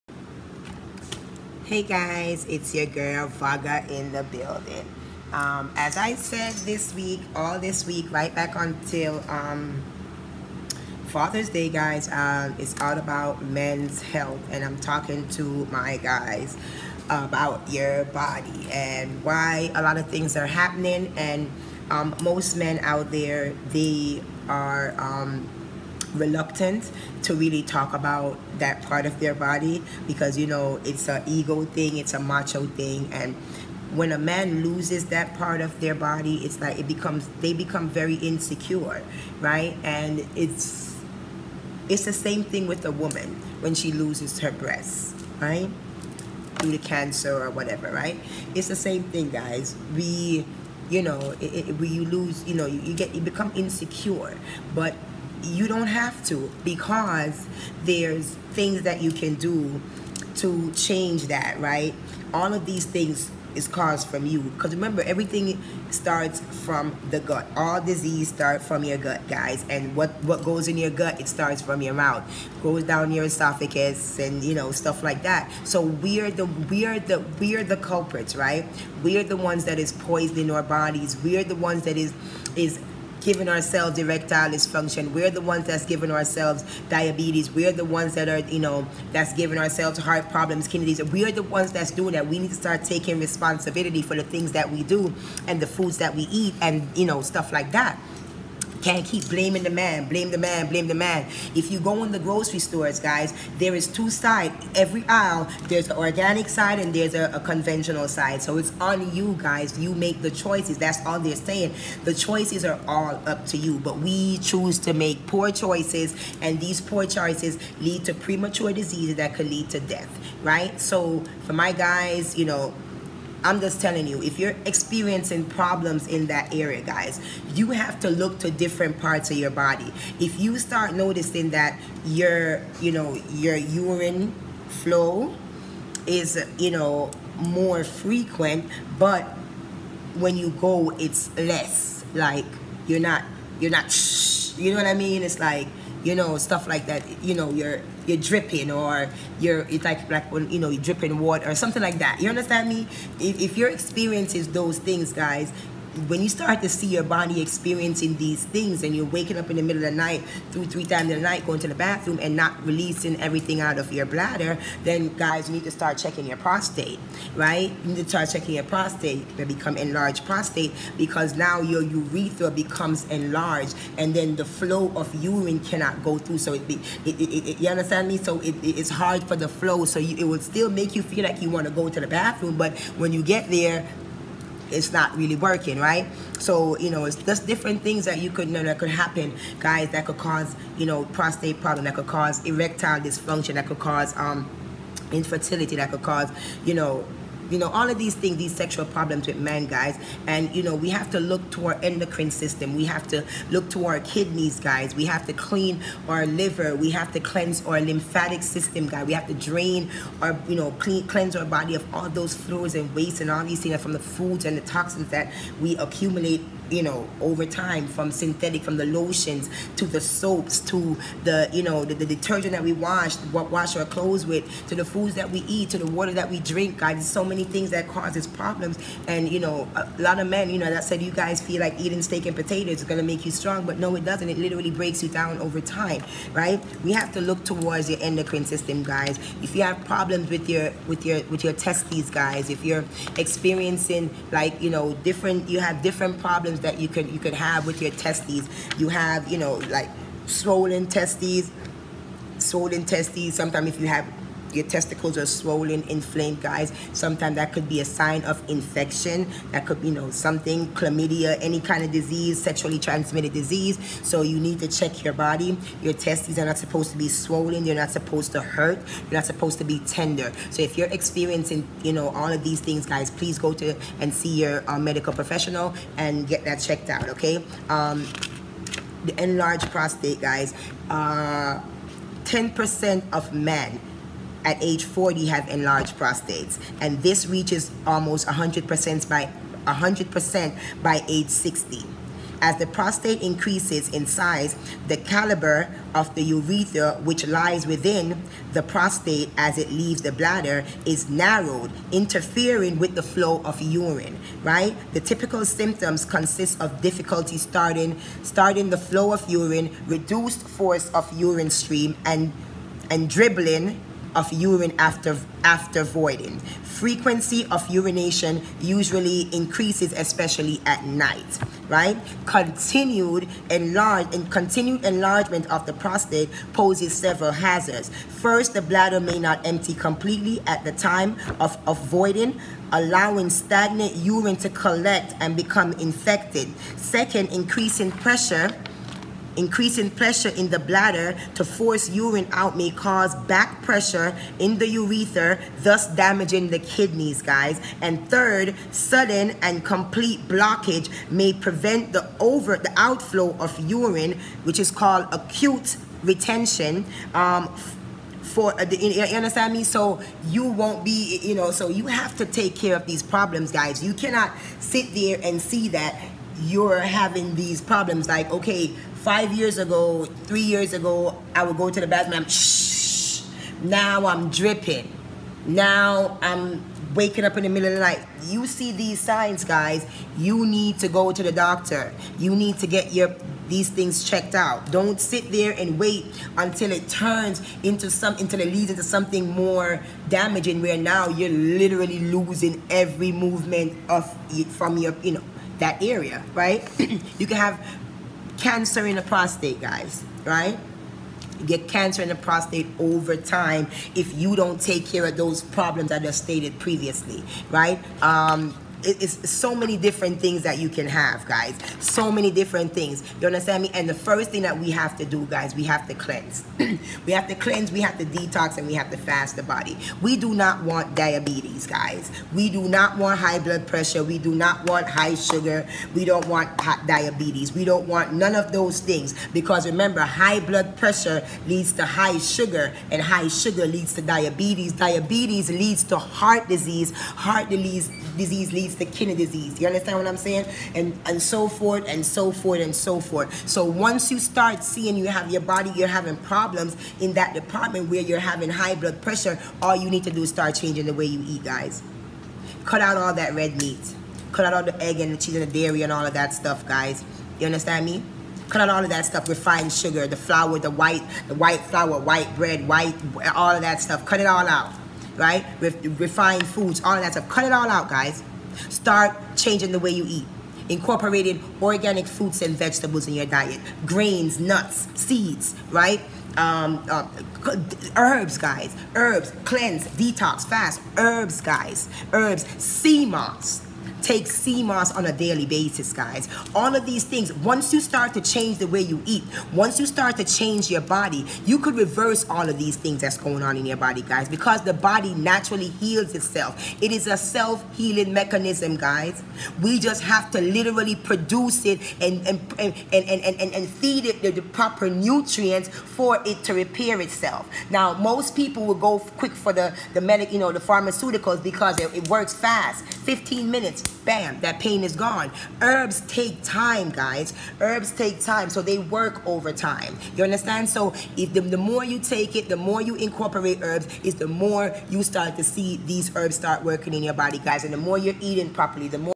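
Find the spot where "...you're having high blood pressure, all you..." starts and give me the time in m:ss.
7:28.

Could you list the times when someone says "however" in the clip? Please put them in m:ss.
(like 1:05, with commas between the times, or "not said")
not said.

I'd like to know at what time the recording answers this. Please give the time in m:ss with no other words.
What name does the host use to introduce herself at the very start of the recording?
0:03.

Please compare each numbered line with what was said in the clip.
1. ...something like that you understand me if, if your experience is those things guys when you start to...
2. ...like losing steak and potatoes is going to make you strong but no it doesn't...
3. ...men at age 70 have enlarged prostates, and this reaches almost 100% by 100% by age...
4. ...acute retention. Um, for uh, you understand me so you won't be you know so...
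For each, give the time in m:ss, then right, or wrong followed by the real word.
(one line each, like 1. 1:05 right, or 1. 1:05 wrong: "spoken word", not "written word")
1. 2:31 right
2. 3:51 wrong: "eating", not "losing"
3. 4:43 wrong: "40", not "70"
4. 5:55 right.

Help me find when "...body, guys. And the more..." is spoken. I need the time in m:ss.
8:47.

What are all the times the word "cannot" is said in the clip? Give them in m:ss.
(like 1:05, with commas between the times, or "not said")
2:55, 6:03.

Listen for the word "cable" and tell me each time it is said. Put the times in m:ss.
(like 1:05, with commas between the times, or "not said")
not said.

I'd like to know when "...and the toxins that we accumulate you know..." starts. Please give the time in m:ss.
3:34.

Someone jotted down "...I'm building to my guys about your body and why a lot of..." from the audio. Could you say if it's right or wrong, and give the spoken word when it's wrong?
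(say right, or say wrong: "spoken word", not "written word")
wrong: "talking", not "building".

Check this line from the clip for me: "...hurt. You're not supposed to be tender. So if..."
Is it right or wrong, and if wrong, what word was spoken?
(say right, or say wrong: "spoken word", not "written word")
right.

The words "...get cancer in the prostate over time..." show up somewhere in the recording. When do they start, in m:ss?
6:41.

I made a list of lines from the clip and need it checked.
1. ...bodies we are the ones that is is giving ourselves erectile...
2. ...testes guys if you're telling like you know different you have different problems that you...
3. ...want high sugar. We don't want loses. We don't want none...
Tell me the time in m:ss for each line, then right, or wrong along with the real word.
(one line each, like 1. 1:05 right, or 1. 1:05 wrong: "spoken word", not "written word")
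1. 1:20 right
2. 4:01 wrong: "experiencing", not "telling"
3. 7:04 wrong: "diabetes", not "loses".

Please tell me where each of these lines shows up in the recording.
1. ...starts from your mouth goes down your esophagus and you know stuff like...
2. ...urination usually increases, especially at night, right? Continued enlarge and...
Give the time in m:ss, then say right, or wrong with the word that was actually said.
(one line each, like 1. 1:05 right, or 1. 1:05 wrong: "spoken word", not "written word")
1. 1:11 right
2. 5:17 right.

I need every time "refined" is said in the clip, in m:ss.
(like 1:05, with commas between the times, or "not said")
7:39, 7:45.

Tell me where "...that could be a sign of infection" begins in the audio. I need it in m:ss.
4:17.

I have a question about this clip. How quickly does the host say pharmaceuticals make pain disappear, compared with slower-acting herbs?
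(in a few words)
15 minutes.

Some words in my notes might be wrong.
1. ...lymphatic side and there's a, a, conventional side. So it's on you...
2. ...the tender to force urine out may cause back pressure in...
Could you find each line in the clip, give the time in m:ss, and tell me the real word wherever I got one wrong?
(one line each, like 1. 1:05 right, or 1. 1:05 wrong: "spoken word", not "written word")
1. 1:45 wrong: "organic", not "lymphatic"
2. 5:40 wrong: "bladder", not "tender".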